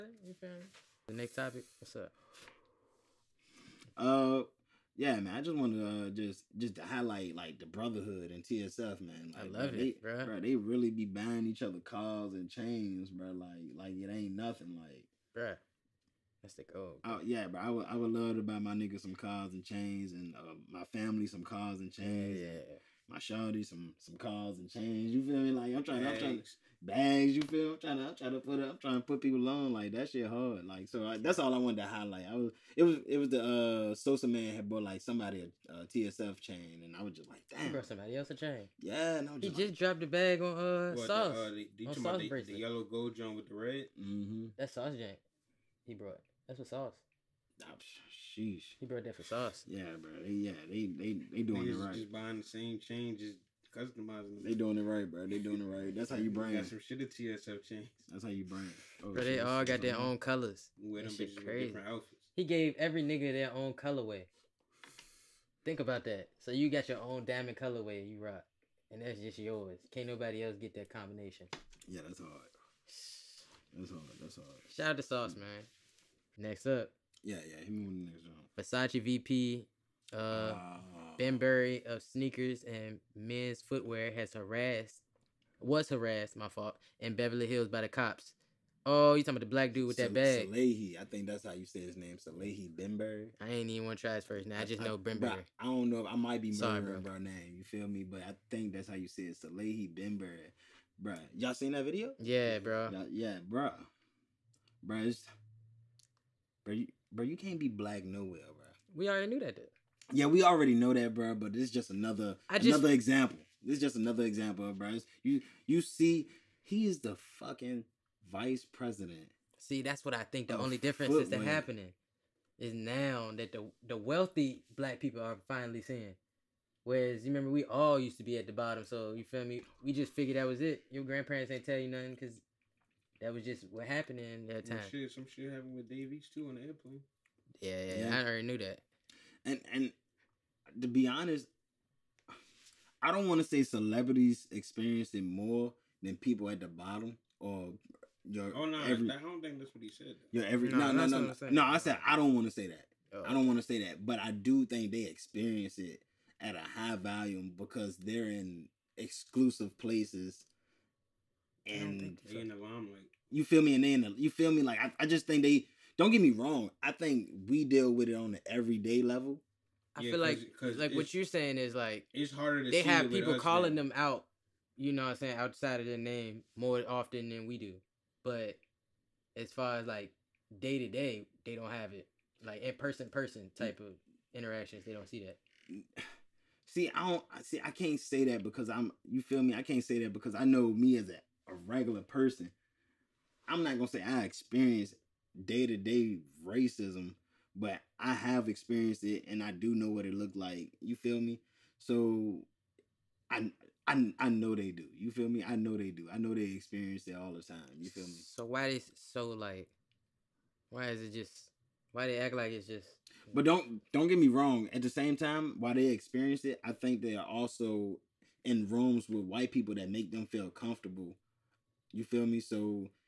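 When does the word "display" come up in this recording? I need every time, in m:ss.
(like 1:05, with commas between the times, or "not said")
not said.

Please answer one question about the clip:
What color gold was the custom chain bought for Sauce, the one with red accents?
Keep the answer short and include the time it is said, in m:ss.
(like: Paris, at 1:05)
Yellow, at 0:42.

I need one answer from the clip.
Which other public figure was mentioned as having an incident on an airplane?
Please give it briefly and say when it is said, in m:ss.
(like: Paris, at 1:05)
Dave East, at 2:15.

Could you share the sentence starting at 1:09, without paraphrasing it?
Can't nobody else get that combination.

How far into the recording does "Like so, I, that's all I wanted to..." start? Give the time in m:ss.
0:30.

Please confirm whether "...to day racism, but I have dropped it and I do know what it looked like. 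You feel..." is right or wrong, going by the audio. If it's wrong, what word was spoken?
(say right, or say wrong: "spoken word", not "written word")
wrong: "experienced", not "dropped".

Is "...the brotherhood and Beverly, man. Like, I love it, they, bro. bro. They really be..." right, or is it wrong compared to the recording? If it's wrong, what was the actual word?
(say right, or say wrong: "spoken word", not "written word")
wrong: "TSF", not "Beverly".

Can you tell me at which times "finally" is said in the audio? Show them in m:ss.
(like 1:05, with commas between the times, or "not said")
2:05.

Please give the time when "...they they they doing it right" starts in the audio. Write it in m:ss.
0:50.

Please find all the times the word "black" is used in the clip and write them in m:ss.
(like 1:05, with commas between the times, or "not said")
1:29, 1:47, 2:04.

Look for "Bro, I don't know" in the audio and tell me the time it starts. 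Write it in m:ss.
1:35.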